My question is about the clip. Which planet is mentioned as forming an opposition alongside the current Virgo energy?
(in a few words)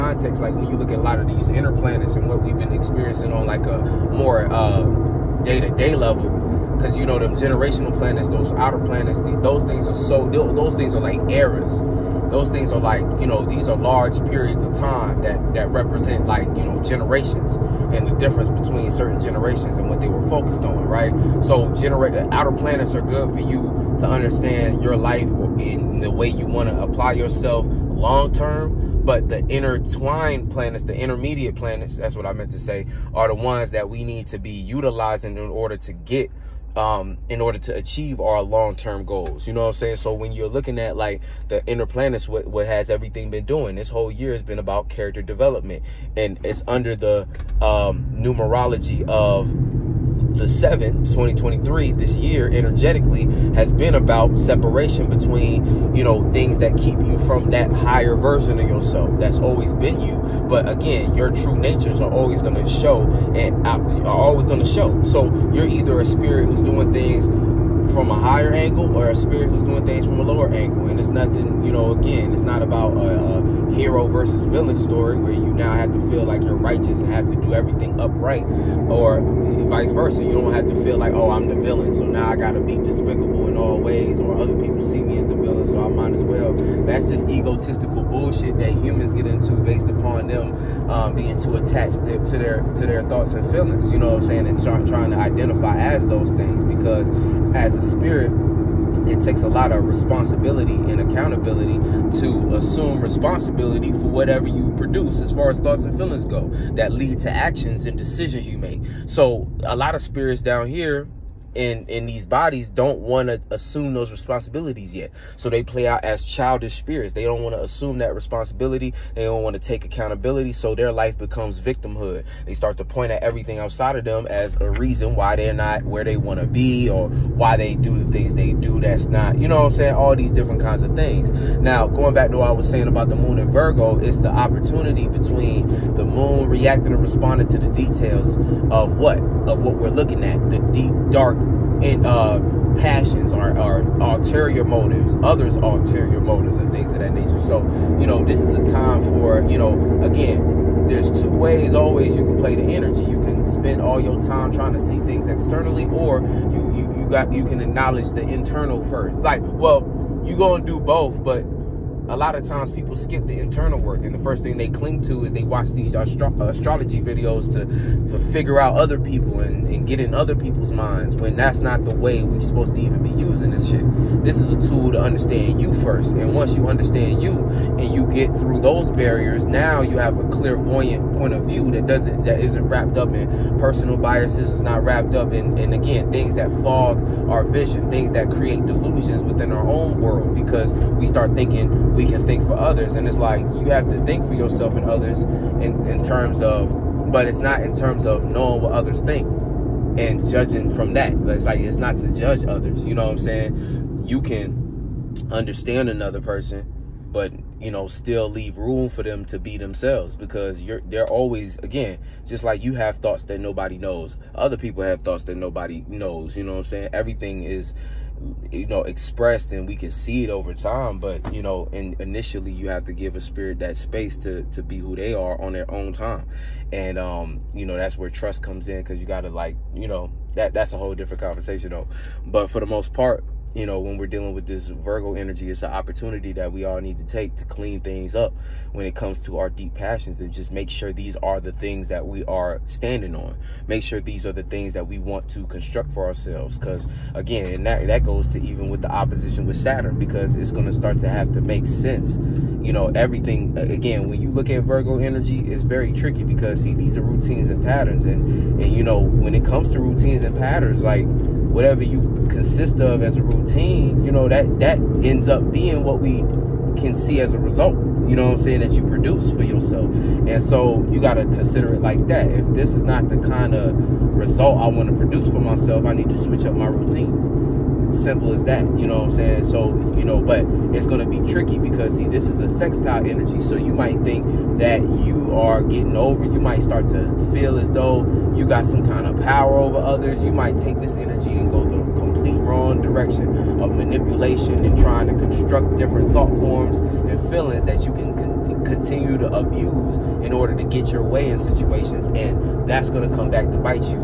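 Saturn.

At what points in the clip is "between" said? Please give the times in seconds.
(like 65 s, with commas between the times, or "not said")
18 s, 55 s, 135 s.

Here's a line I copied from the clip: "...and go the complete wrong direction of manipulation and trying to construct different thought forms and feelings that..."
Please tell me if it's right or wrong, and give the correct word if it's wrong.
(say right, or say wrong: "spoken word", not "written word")
right.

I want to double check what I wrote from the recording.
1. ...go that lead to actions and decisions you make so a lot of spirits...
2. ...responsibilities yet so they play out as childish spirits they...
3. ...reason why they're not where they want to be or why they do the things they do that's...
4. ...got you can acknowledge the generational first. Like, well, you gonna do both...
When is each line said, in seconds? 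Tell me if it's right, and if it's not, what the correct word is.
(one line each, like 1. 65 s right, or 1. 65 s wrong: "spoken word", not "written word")
1. 106 s right
2. 114 s right
3. 124 s right
4. 157 s wrong: "internal", not "generational".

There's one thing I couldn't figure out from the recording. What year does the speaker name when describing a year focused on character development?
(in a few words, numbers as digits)
2023.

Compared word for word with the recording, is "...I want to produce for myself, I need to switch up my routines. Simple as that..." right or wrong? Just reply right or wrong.
right.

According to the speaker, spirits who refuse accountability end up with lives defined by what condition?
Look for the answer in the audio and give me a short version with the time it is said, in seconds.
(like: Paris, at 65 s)
Victimhood, at 121 s.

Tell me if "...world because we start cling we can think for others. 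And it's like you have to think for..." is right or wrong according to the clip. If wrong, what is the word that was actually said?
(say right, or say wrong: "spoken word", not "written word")
wrong: "thinking", not "cling".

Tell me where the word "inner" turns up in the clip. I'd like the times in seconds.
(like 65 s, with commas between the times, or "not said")
1 s, 41 s.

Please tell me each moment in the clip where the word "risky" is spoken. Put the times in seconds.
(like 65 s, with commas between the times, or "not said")
not said.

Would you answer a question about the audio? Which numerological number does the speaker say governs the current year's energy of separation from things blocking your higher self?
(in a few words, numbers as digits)
7.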